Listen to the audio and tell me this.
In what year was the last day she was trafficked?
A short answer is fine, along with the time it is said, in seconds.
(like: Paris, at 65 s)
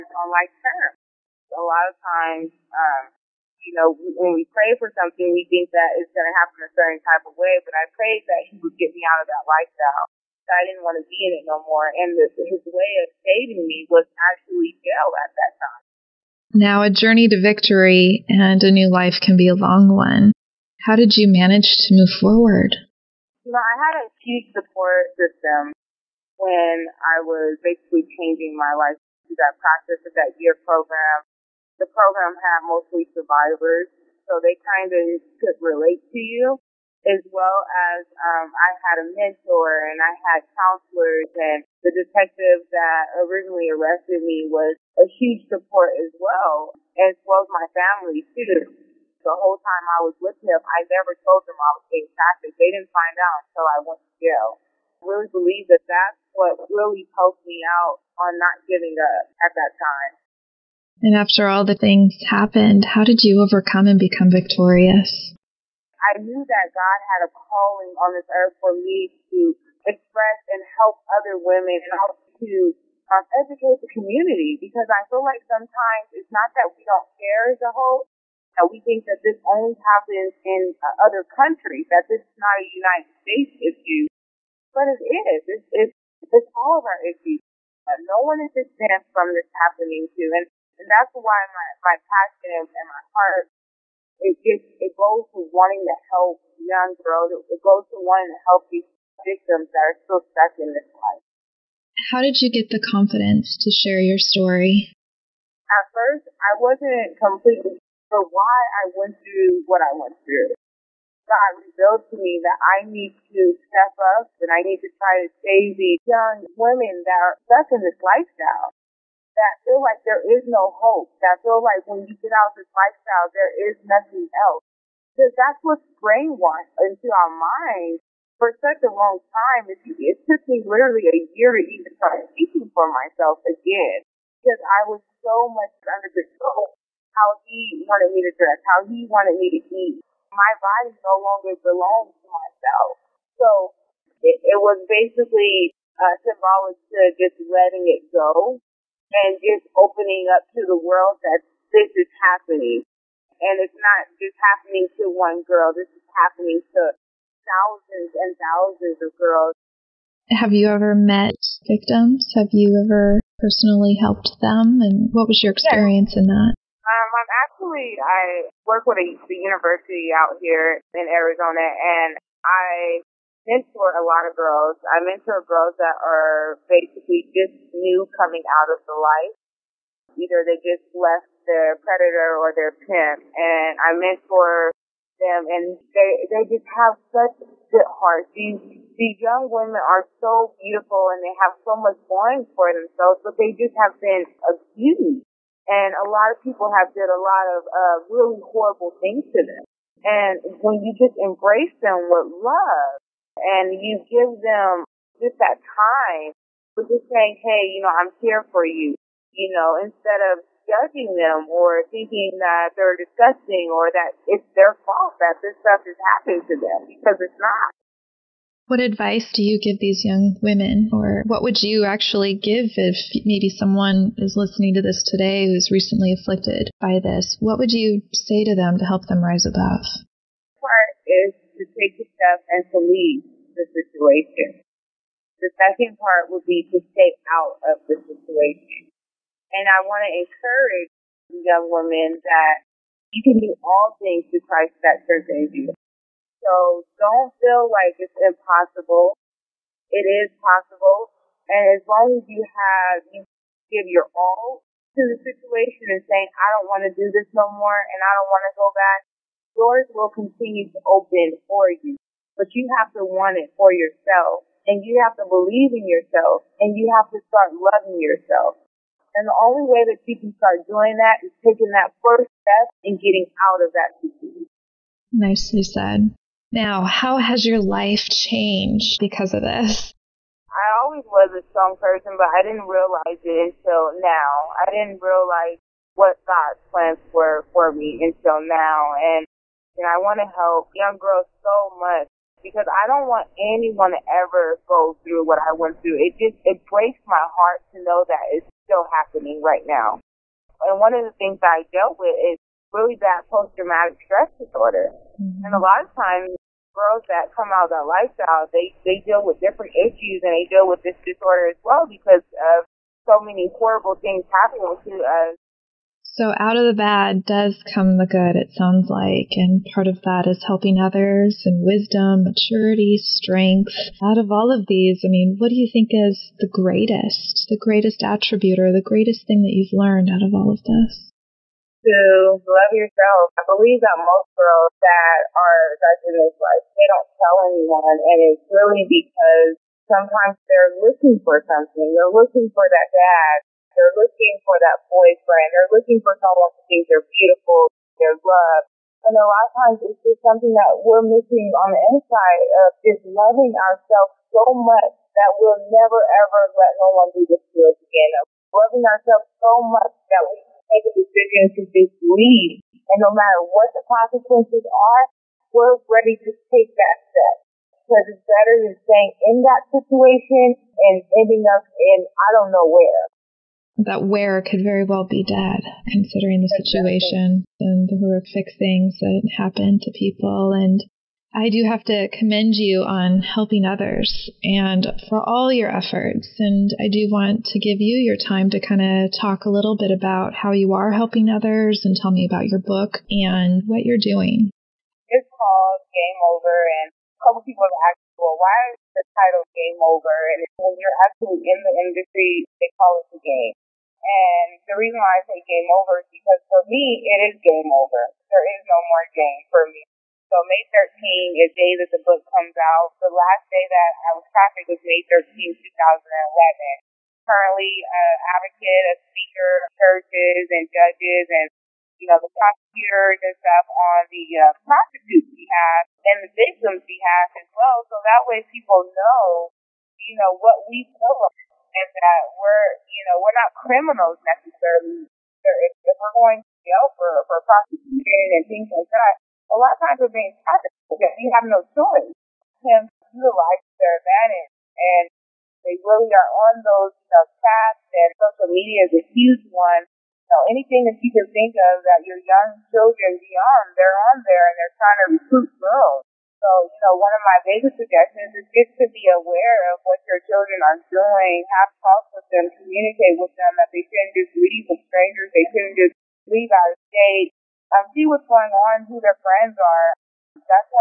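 2011, at 415 s.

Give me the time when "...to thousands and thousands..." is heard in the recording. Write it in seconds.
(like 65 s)
156 s.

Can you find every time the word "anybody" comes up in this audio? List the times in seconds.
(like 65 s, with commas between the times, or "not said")
not said.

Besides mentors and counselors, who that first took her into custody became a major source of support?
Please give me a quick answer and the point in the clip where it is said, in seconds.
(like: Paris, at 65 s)
The detective, at 41 s.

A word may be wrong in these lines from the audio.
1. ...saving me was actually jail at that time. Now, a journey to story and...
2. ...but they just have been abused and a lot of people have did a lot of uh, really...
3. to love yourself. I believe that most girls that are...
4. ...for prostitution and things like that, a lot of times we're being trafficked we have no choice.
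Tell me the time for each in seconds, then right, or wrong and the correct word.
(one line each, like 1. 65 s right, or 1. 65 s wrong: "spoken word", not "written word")
1. 13 s wrong: "victory", not "story"
2. 193 s right
3. 331 s right
4. 437 s right.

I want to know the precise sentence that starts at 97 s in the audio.
It, it goes to wanting to help these victims that are still stuck in this life.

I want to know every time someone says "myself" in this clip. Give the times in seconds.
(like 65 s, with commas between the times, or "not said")
132 s, 142 s.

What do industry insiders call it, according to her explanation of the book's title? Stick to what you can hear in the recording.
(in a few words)
The game.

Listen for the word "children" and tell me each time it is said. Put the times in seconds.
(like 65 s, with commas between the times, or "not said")
452 s, 460 s.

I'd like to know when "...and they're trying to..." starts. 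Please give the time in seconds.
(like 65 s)
454 s.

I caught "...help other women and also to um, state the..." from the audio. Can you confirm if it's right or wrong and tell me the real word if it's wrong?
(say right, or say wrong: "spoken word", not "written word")
wrong: "educate", not "state".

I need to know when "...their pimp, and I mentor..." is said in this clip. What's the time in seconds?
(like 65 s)
182 s.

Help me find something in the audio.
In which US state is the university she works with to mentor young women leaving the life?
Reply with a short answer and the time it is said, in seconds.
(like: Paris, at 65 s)
Arizona, at 171 s.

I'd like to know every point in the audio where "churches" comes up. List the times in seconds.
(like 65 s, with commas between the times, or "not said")
419 s.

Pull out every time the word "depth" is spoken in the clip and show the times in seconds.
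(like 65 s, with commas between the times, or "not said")
not said.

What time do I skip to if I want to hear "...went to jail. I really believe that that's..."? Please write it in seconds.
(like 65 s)
53 s.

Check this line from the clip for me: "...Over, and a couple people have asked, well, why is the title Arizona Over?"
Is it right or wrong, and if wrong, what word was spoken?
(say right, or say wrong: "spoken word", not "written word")
wrong: "Game", not "Arizona".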